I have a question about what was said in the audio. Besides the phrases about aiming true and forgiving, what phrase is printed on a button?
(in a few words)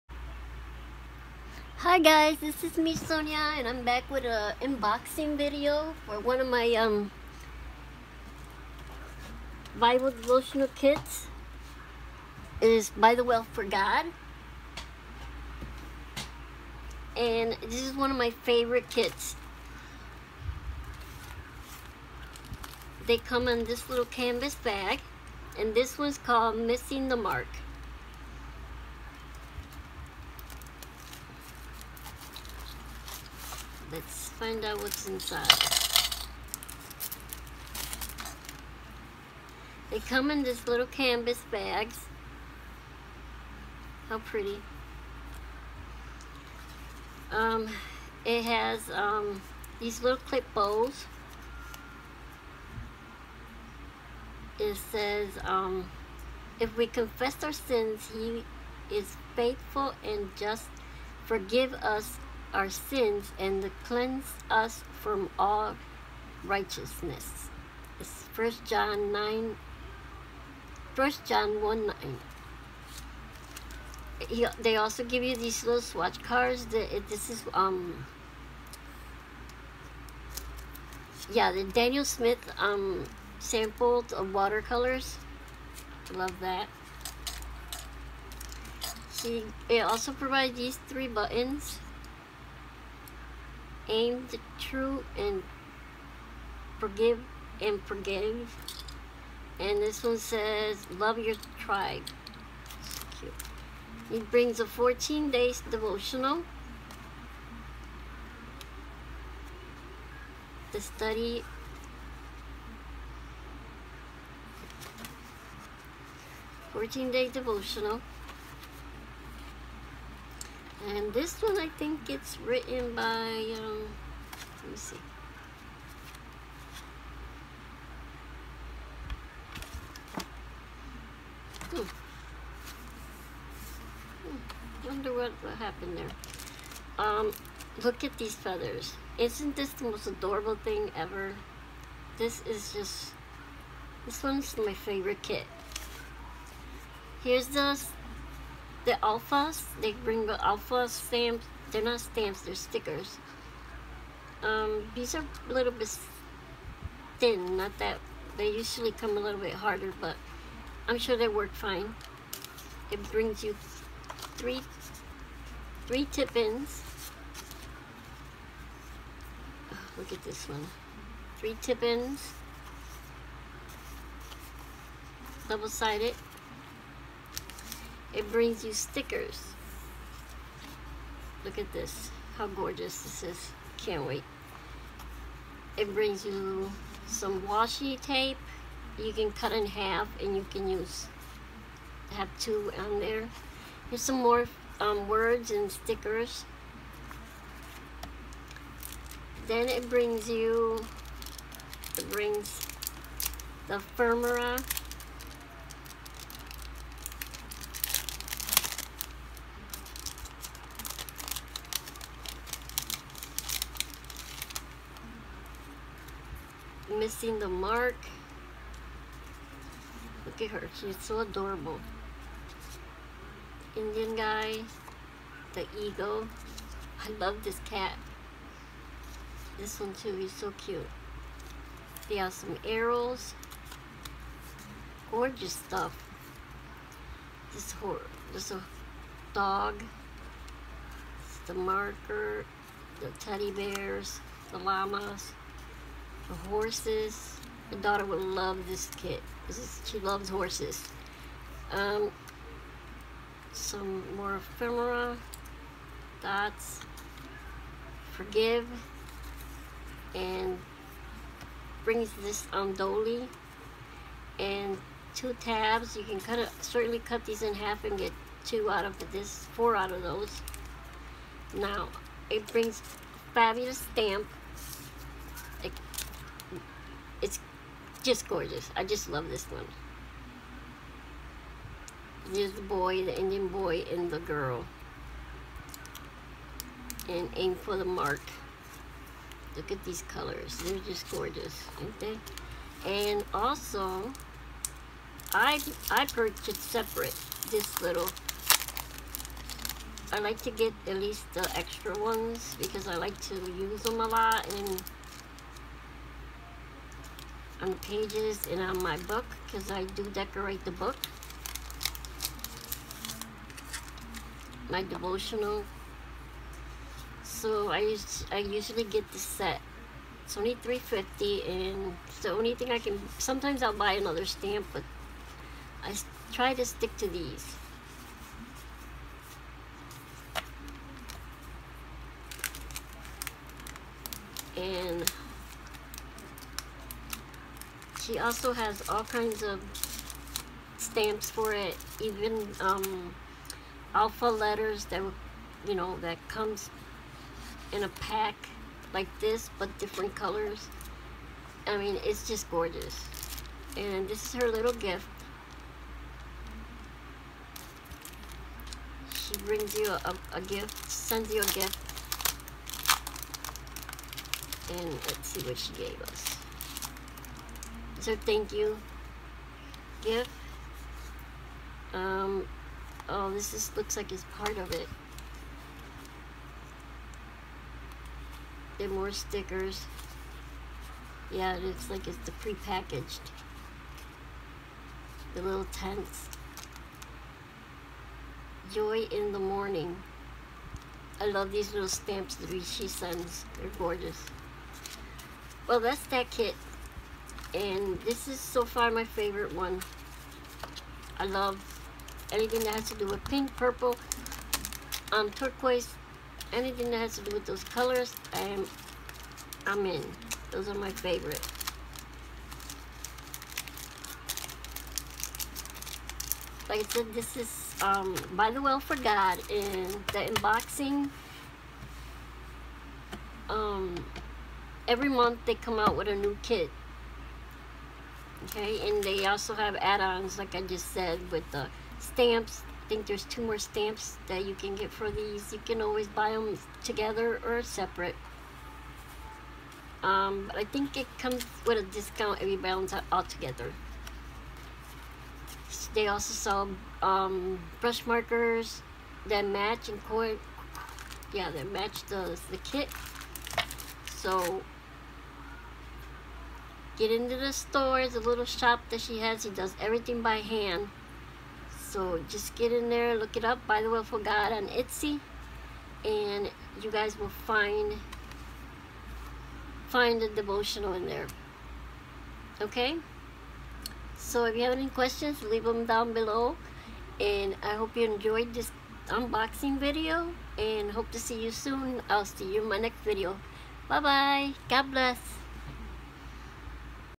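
Love your tribe.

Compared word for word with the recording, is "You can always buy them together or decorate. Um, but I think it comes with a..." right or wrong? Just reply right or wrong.
wrong.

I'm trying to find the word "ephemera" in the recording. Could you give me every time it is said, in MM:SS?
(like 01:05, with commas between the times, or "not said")
03:23, 04:14.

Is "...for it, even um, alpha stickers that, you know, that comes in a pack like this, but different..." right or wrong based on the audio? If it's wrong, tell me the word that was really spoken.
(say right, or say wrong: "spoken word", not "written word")
wrong: "letters", not "stickers".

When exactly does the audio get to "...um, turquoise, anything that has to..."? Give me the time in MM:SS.
06:45.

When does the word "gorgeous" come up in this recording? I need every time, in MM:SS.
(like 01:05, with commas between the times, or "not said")
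03:02, 03:55, 04:38, 04:51, 05:52, 06:33.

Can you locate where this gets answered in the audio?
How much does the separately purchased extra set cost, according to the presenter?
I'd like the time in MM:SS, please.
05:20.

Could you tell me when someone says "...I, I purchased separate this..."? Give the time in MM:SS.
04:55.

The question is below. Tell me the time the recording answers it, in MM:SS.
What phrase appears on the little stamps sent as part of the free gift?
06:28.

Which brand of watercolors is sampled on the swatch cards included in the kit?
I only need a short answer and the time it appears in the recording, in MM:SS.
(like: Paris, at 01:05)
Daniel Smith, at 01:21.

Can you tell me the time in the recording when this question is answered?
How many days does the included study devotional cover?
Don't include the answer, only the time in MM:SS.
01:44.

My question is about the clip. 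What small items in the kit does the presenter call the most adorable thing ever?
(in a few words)
Feathers.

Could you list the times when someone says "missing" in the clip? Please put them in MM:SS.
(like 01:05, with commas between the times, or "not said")
00:26, 03:36.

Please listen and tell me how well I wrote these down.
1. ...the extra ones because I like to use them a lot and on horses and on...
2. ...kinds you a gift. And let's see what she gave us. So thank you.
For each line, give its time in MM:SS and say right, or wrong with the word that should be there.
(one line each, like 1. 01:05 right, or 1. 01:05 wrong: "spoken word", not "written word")
1. 05:01 wrong: "pages", not "horses"
2. 06:00 wrong: "sends", not "kinds".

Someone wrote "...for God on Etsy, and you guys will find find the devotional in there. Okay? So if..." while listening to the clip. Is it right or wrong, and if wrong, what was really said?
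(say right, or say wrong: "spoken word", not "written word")
right.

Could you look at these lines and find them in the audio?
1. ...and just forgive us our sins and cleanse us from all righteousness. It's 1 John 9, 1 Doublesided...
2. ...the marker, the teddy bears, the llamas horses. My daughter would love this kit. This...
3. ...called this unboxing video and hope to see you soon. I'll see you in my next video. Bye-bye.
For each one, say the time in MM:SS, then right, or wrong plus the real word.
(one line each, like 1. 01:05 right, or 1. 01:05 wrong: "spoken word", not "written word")
1. 01:00 wrong: "John", not "Doublesided"
2. 04:01 right
3. 07:58 wrong: "enjoyed", not "called".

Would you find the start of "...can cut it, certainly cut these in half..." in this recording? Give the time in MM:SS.
04:26.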